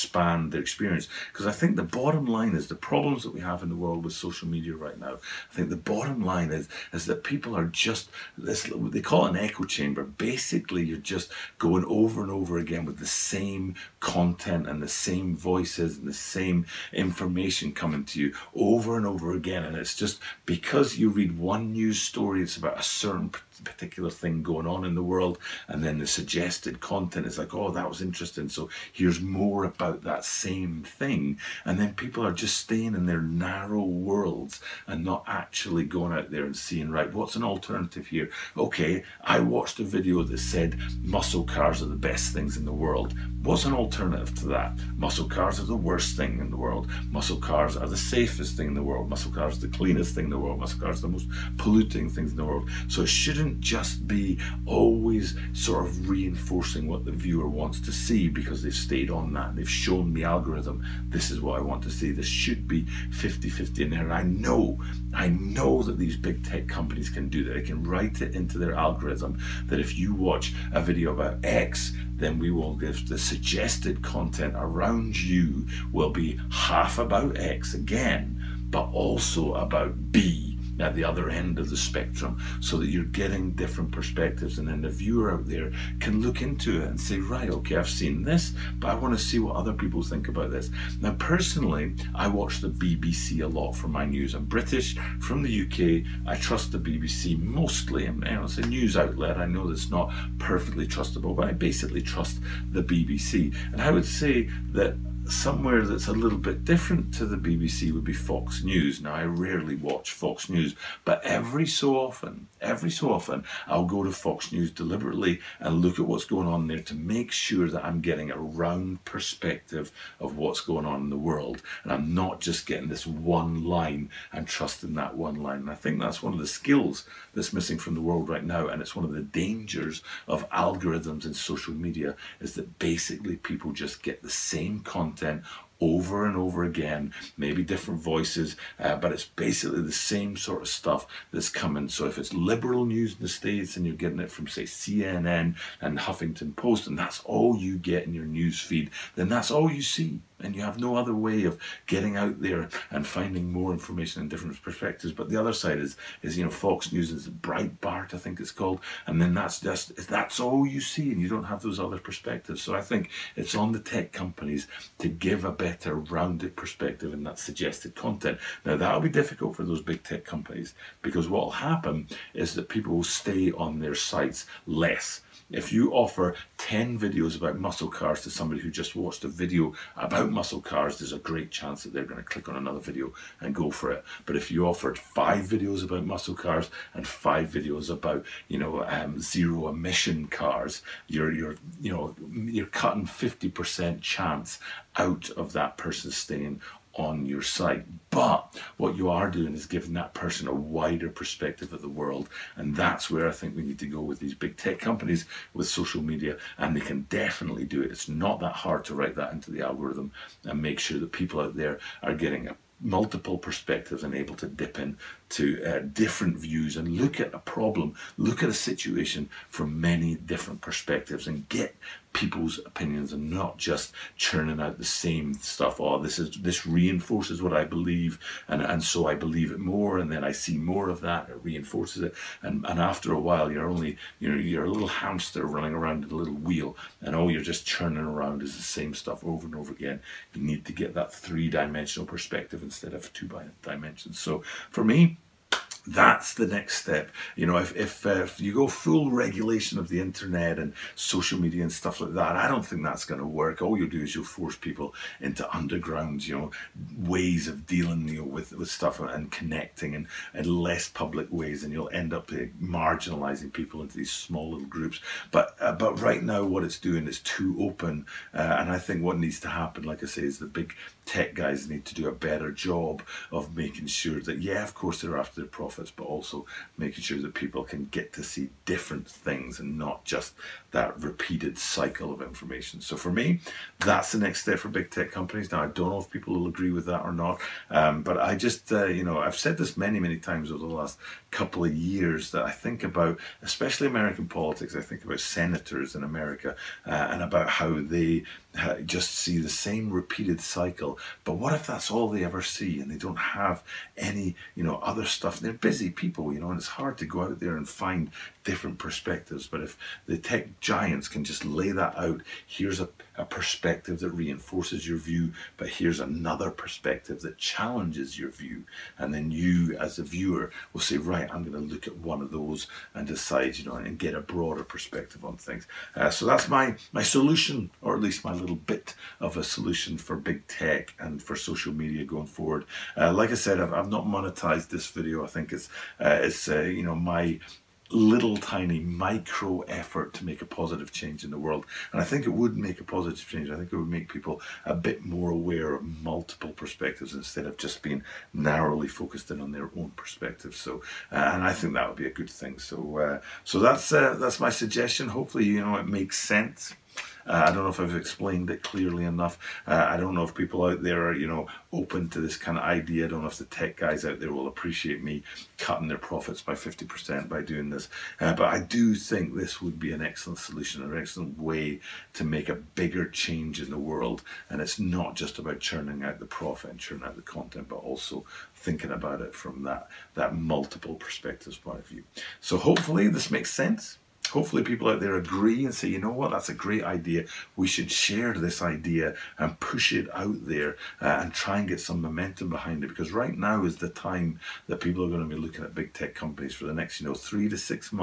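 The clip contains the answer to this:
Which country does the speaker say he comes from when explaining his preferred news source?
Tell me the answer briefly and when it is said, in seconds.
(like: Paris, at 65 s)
UK, at 95 s.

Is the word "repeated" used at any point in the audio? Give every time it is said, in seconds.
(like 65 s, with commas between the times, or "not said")
281 s, 299 s.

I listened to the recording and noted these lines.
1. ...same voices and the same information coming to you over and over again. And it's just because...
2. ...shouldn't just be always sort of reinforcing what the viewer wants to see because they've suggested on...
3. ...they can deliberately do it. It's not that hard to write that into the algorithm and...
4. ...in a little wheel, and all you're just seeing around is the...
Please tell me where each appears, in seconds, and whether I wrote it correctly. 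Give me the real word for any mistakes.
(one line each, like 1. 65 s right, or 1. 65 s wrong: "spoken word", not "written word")
1. 14 s right
2. 53 s wrong: "stayed", not "suggested"
3. 206 s wrong: "definitely", not "deliberately"
4. 236 s wrong: "churning", not "seeing".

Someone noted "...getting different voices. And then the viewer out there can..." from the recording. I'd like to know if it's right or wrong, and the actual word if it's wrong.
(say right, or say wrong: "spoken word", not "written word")
wrong: "perspectives", not "voices".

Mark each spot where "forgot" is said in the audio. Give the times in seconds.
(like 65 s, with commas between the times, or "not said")
not said.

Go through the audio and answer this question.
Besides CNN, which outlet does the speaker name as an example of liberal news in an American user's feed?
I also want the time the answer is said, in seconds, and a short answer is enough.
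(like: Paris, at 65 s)
Huffington Post, at 145 s.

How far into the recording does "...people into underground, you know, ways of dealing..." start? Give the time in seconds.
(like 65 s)
254 s.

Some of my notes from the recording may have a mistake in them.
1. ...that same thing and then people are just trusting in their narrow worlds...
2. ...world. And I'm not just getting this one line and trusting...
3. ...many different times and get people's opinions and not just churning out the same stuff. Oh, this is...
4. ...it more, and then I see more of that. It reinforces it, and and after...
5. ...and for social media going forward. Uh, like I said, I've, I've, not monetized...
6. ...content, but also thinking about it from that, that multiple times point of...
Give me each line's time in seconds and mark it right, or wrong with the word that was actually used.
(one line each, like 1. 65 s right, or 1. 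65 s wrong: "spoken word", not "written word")
1. 30 s wrong: "staying", not "trusting"
2. 121 s right
3. 219 s wrong: "perspectives", not "times"
4. 229 s right
5. 330 s right
6. 377 s wrong: "perspectives", not "times".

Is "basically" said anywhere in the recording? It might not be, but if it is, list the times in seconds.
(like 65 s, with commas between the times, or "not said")
10 s, 101 s, 132 s, 139 s.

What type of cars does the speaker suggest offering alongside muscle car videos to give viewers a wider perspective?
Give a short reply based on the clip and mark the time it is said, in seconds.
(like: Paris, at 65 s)
zero emission cars, at 189 s.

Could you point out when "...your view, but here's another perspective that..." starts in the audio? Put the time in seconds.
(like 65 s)
314 s.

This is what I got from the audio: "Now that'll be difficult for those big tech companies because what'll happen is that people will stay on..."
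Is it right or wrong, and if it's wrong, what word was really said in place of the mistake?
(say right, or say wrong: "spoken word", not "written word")
right.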